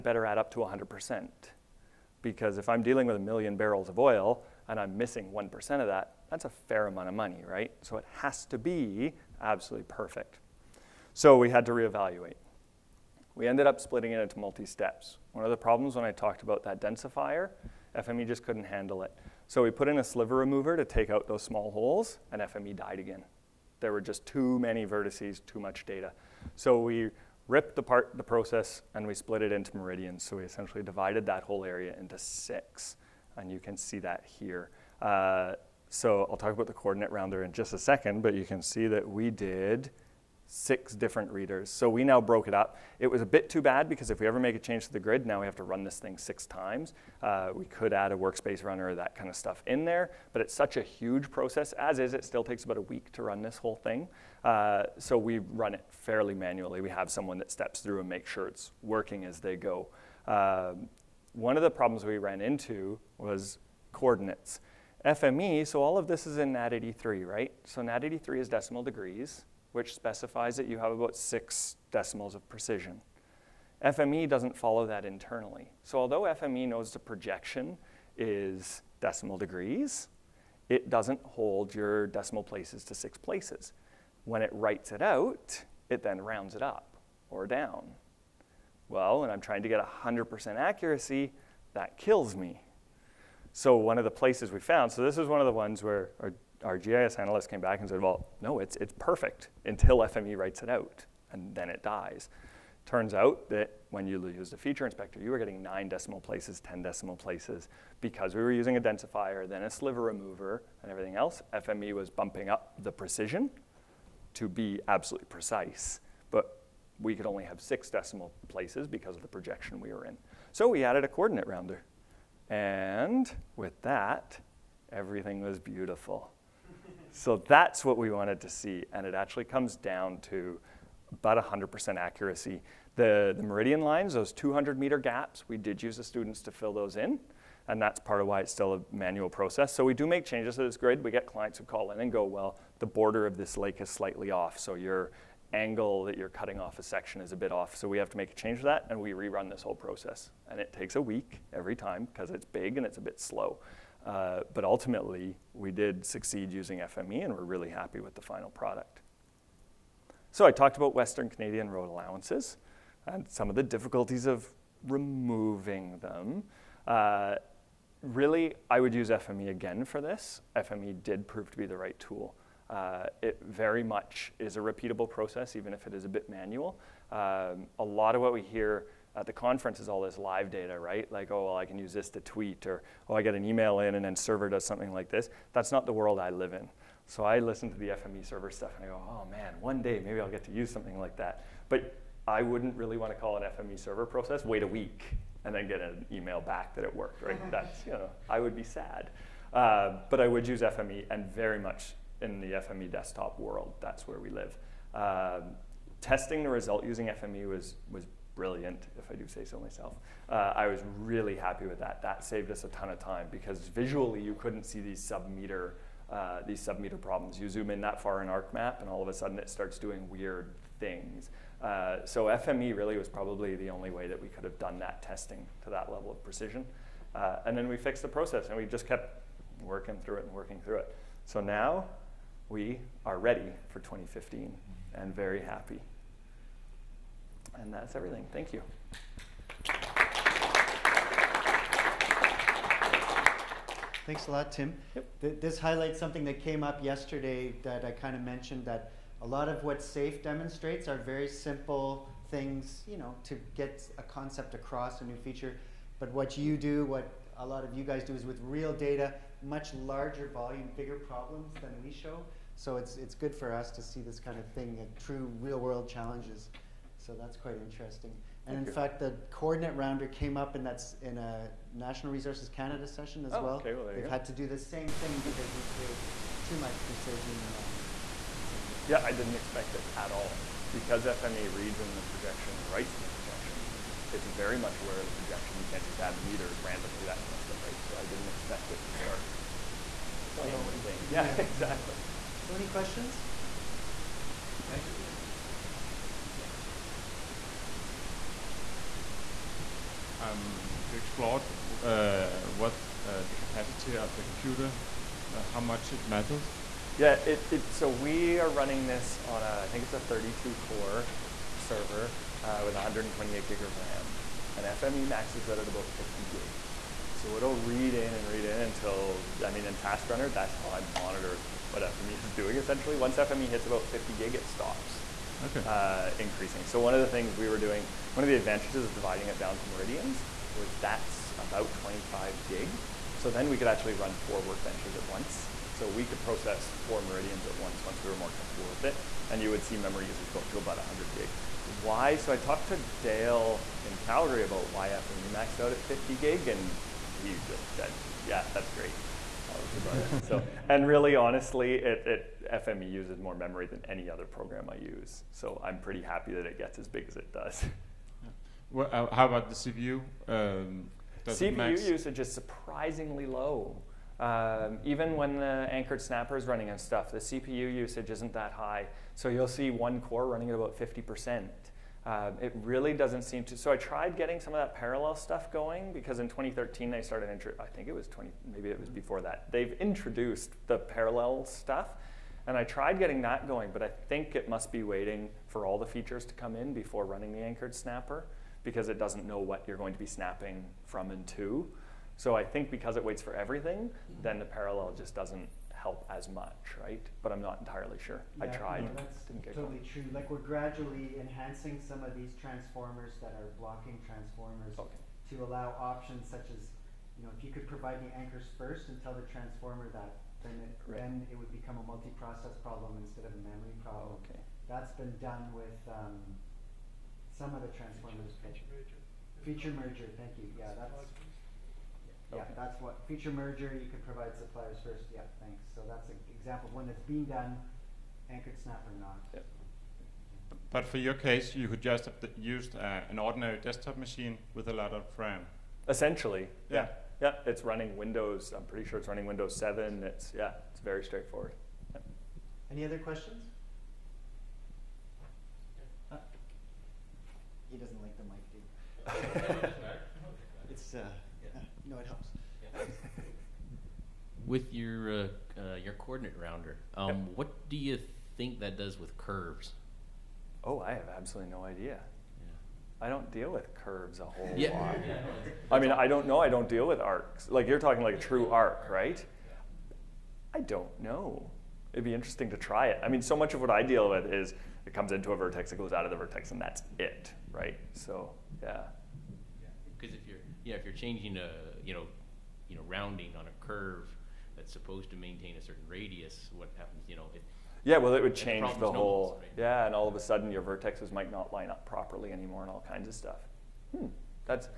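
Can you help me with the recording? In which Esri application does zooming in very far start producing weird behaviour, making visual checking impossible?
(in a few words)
ArcMap.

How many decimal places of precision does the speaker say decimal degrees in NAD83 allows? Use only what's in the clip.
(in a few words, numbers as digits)
6.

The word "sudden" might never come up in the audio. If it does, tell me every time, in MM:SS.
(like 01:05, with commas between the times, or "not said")
03:39, 08:10.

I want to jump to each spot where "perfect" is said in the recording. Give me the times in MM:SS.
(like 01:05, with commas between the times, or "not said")
00:09, 01:38.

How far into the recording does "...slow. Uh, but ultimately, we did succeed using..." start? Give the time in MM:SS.
02:33.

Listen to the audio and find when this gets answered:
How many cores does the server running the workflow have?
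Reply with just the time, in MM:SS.
05:09.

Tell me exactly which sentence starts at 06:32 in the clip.
So I think because it waits for everything, mm-hmm.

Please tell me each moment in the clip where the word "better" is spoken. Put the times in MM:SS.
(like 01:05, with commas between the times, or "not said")
00:00.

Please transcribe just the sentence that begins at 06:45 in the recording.
to allow options such as, you know, if you could provide the anchors first and tell the transformer that, then it, right.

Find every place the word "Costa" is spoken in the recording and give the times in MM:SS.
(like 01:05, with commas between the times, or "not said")
not said.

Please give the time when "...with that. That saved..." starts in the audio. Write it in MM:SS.
03:31.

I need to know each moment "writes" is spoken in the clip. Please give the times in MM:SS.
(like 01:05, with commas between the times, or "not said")
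01:24, 01:40, 04:42.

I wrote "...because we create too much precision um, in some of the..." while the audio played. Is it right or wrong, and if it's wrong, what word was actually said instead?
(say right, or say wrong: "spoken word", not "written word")
right.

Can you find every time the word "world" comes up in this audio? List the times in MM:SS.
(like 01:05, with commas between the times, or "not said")
03:05, 03:23, 04:25.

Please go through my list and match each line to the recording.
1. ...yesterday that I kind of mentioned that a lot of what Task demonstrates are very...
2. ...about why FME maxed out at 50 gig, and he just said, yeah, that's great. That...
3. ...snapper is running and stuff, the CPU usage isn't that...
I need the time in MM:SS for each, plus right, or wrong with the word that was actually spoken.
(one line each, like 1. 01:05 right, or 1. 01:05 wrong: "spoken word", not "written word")
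1. 04:06 wrong: "SAFE", not "Task"
2. 05:44 right
3. 06:06 right.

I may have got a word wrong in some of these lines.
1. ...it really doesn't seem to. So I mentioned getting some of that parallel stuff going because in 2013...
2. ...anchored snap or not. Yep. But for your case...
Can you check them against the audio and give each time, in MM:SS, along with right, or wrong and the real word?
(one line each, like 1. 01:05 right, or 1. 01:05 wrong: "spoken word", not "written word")
1. 06:12 wrong: "tried", not "mentioned"
2. 07:08 right.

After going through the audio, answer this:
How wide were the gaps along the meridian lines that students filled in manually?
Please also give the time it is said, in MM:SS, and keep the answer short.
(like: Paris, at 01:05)
200 meters, at 02:14.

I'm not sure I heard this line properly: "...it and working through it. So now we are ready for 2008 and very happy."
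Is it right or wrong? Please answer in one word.
wrong.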